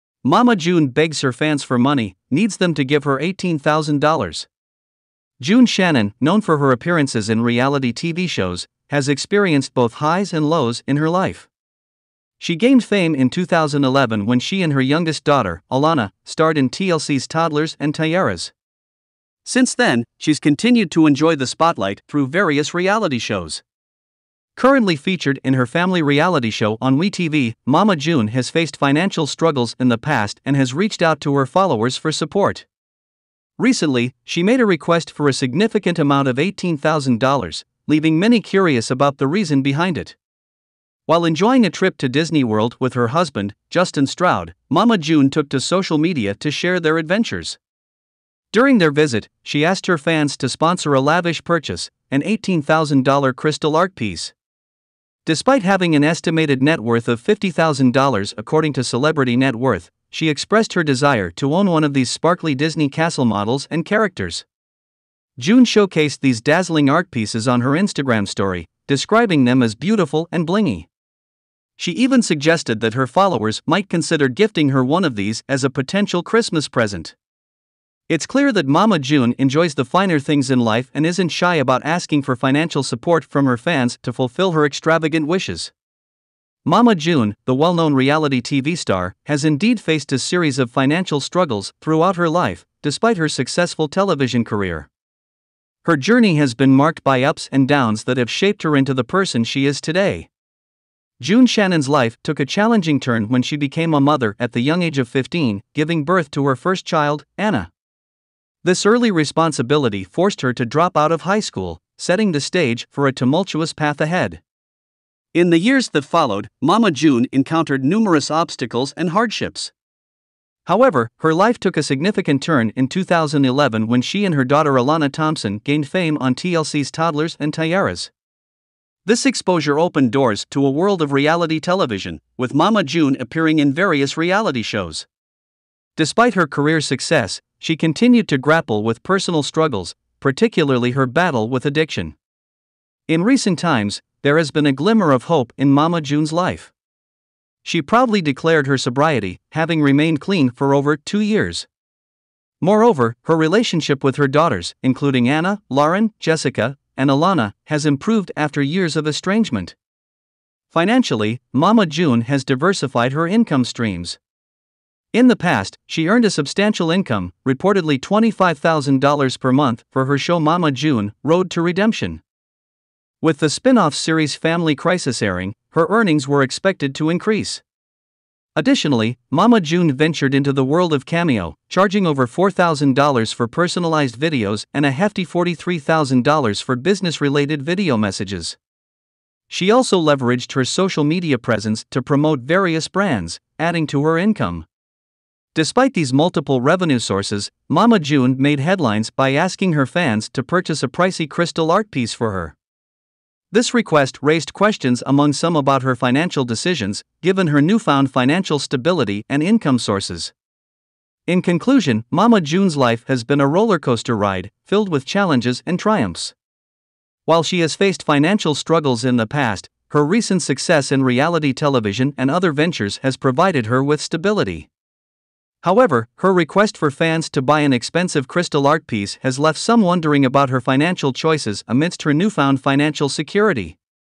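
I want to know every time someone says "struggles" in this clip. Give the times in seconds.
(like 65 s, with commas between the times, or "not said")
29 s, 91 s, 139 s, 218 s.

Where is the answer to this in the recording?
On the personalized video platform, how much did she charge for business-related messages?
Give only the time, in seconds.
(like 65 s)
185 s.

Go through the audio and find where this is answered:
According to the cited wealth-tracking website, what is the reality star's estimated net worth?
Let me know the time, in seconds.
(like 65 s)
57 s.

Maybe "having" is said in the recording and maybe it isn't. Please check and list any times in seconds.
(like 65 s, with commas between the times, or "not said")
55 s, 149 s.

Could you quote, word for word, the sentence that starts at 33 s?
Recently, she made a request for a significant amount of $18,000, leaving many curious about the reason behind it.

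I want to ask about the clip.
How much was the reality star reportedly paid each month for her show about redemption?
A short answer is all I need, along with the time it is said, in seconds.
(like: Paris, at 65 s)
$25,000, at 167 s.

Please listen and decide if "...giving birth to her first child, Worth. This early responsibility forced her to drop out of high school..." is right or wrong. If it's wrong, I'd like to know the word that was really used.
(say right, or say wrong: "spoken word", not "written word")
wrong: "Anna", not "Worth".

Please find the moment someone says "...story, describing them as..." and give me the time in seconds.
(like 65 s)
68 s.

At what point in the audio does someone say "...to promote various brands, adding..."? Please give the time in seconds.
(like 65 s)
191 s.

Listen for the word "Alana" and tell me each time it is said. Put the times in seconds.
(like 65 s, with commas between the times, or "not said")
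15 s, 124 s, 157 s.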